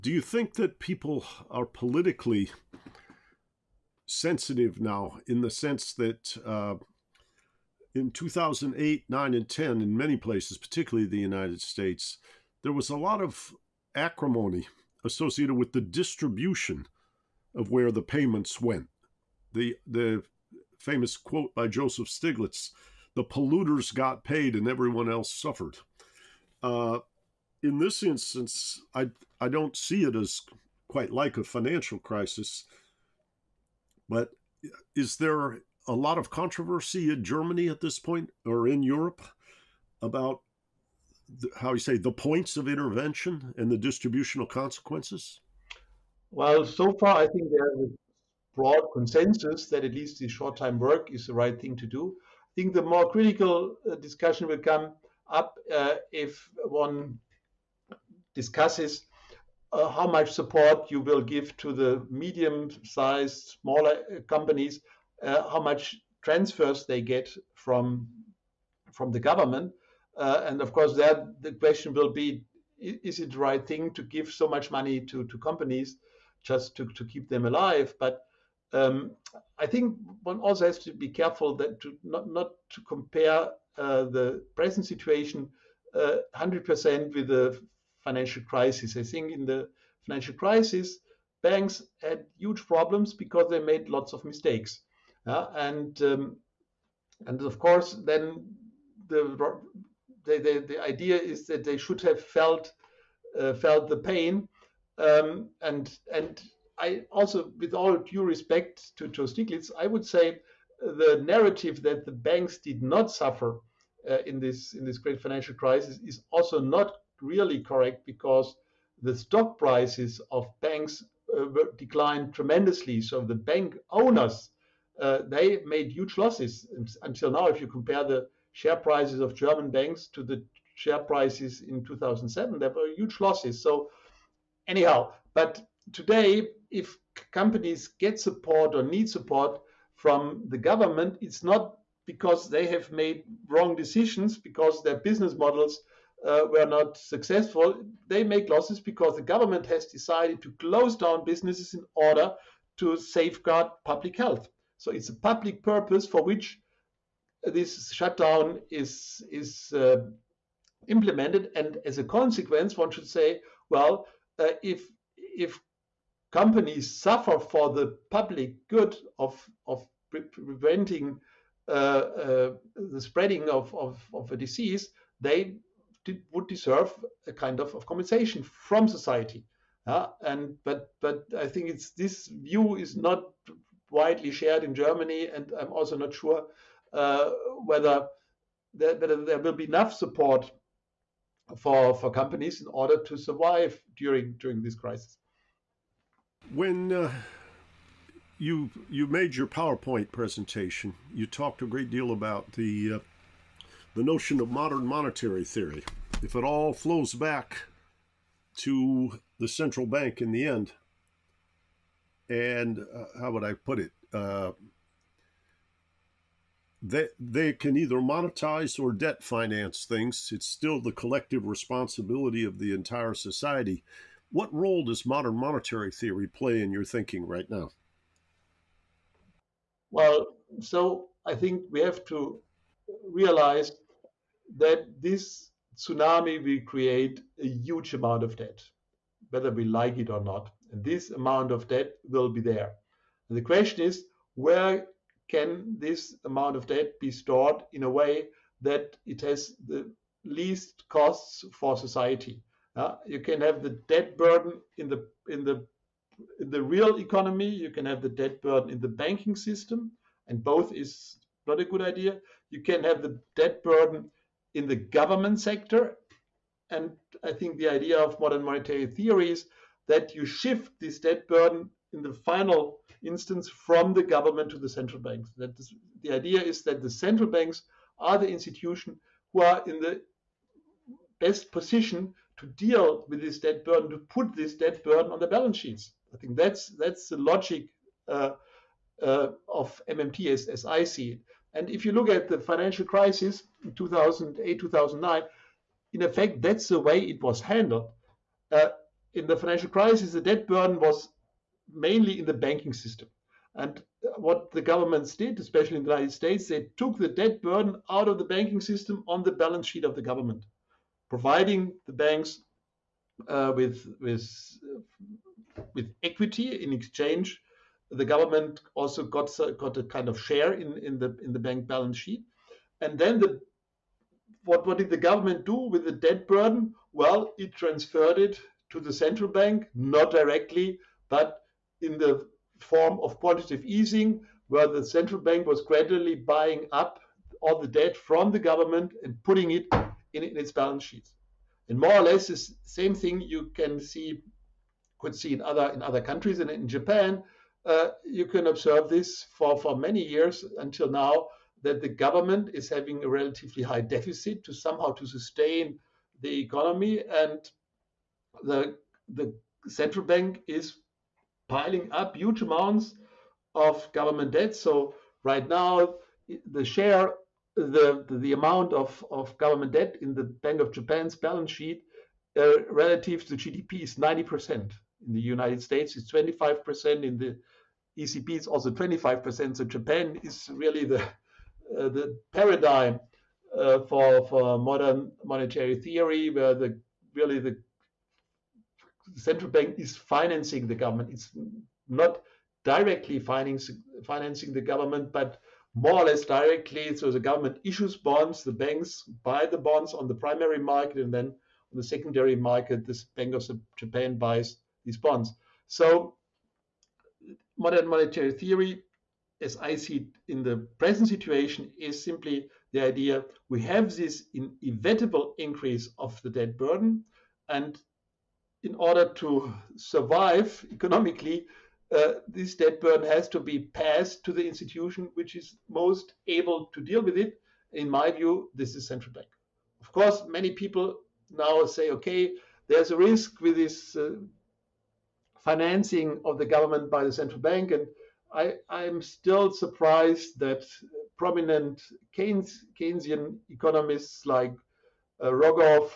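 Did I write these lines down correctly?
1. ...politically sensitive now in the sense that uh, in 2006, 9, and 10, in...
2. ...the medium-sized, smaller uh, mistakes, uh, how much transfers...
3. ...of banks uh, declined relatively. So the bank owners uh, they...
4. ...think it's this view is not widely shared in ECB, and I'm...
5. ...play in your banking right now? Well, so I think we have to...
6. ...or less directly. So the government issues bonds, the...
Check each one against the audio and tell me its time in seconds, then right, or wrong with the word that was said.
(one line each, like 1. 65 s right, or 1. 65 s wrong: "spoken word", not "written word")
1. 1 s wrong: "2008", not "2006"
2. 61 s wrong: "companies", not "mistakes"
3. 120 s wrong: "tremendously", not "relatively"
4. 181 s wrong: "Germany", not "ECB"
5. 226 s wrong: "thinking", not "banking"
6. 396 s right.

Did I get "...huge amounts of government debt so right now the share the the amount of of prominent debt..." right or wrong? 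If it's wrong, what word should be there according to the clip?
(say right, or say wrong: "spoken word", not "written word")
wrong: "government", not "prominent".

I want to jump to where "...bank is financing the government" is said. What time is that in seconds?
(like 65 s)
389 s.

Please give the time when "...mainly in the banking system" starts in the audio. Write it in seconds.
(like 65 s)
301 s.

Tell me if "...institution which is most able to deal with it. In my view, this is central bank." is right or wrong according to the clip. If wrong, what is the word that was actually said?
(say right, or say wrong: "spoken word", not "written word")
right.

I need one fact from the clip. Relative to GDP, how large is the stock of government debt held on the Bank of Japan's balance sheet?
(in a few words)
90%.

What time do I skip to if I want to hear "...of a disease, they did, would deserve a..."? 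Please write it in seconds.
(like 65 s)
174 s.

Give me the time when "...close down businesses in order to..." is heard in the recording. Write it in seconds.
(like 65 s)
150 s.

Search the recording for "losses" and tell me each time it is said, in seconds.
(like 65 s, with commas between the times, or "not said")
126 s, 133 s, 148 s.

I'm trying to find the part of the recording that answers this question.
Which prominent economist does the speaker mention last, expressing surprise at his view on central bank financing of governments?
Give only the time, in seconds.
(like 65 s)
445 s.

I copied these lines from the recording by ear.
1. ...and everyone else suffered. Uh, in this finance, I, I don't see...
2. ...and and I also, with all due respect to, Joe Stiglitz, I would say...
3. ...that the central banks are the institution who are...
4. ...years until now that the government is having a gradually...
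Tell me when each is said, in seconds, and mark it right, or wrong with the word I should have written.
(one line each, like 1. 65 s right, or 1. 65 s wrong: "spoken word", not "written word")
1. 24 s wrong: "instance", not "finance"
2. 105 s right
3. 276 s right
4. 350 s wrong: "relatively", not "gradually".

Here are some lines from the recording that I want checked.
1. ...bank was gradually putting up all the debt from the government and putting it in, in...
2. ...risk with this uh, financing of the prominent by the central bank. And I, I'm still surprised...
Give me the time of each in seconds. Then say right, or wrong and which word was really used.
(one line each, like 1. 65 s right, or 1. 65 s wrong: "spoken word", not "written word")
1. 335 s wrong: "buying", not "putting"
2. 432 s wrong: "government", not "prominent".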